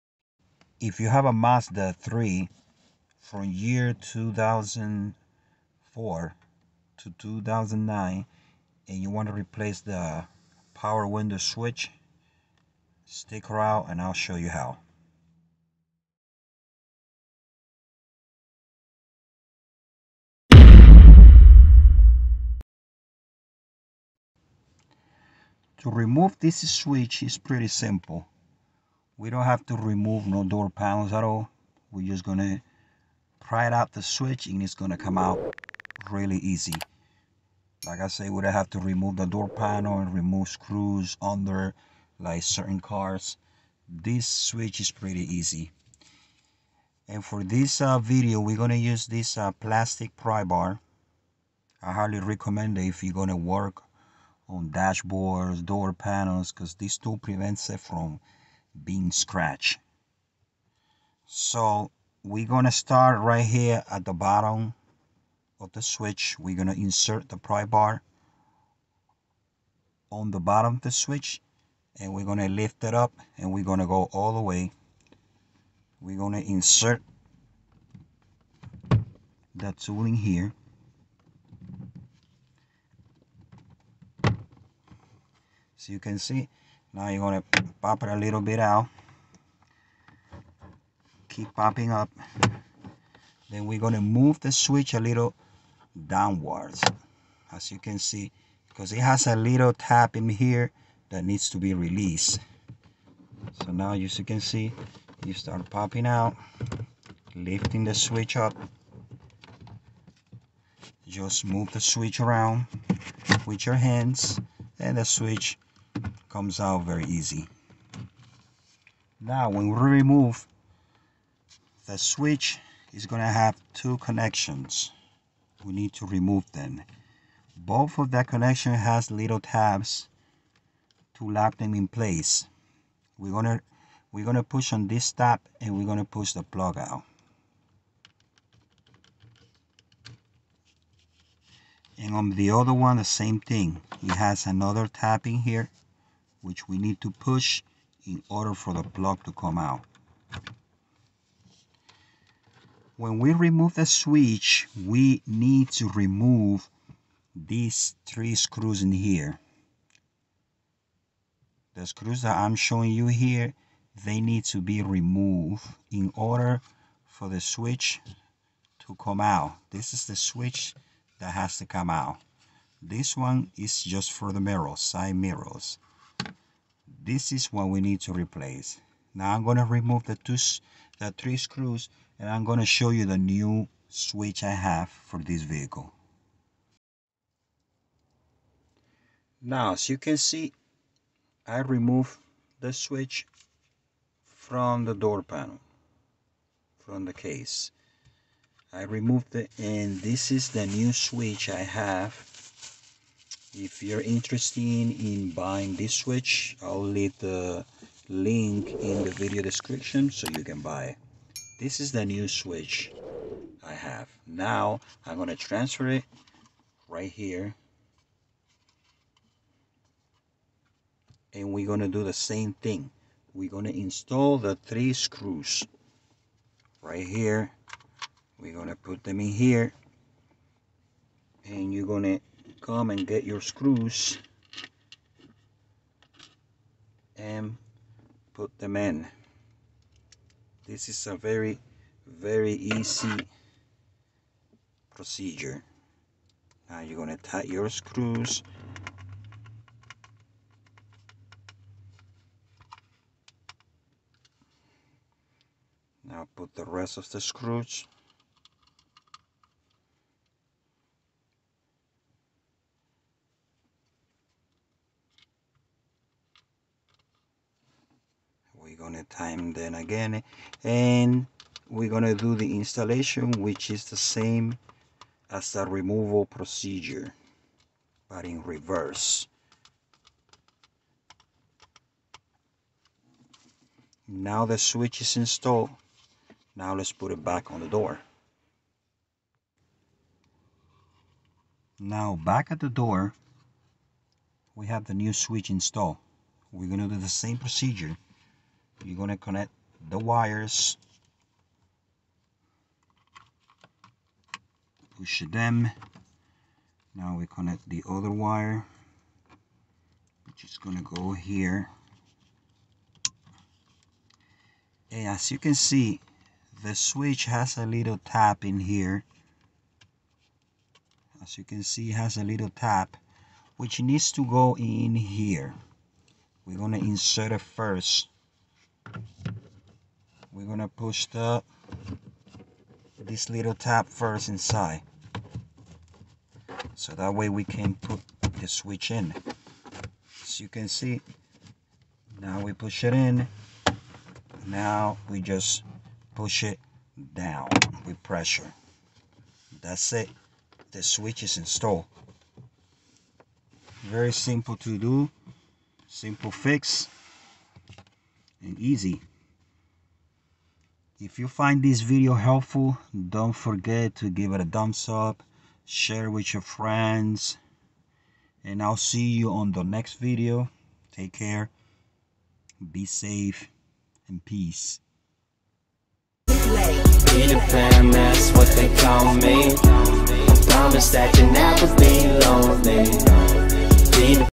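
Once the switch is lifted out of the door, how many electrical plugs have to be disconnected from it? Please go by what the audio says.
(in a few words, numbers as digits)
2.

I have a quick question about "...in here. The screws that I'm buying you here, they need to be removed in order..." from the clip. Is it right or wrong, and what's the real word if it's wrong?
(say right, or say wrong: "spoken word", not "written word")
wrong: "showing", not "buying".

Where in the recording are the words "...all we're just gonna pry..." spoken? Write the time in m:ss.
0:31.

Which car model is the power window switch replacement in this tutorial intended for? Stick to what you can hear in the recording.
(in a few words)
Mazda 3.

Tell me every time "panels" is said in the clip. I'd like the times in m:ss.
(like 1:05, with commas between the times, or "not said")
0:30, 0:39, 0:55, 3:15.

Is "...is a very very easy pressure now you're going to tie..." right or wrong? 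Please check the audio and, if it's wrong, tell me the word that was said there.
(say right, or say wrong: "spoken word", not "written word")
wrong: "procedure", not "pressure".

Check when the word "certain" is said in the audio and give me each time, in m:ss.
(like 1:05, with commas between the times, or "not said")
0:42.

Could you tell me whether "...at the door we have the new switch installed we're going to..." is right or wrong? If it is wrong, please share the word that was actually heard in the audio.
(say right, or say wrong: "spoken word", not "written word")
right.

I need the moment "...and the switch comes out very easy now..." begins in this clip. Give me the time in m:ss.
1:54.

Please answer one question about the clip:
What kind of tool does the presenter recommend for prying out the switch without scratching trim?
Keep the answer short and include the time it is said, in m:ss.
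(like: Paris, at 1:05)
plastic pry bar, at 0:49.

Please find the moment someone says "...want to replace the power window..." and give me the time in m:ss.
0:09.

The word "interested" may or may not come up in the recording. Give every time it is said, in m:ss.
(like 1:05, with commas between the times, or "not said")
3:24.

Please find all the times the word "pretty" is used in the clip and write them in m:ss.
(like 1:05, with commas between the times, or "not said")
0:27, 0:44.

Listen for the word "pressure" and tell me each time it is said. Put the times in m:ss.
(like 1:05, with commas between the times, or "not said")
5:48.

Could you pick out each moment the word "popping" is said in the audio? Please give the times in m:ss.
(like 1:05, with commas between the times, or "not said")
1:31, 1:45.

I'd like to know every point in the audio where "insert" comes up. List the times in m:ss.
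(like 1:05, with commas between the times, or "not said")
1:06, 1:16, 5:26.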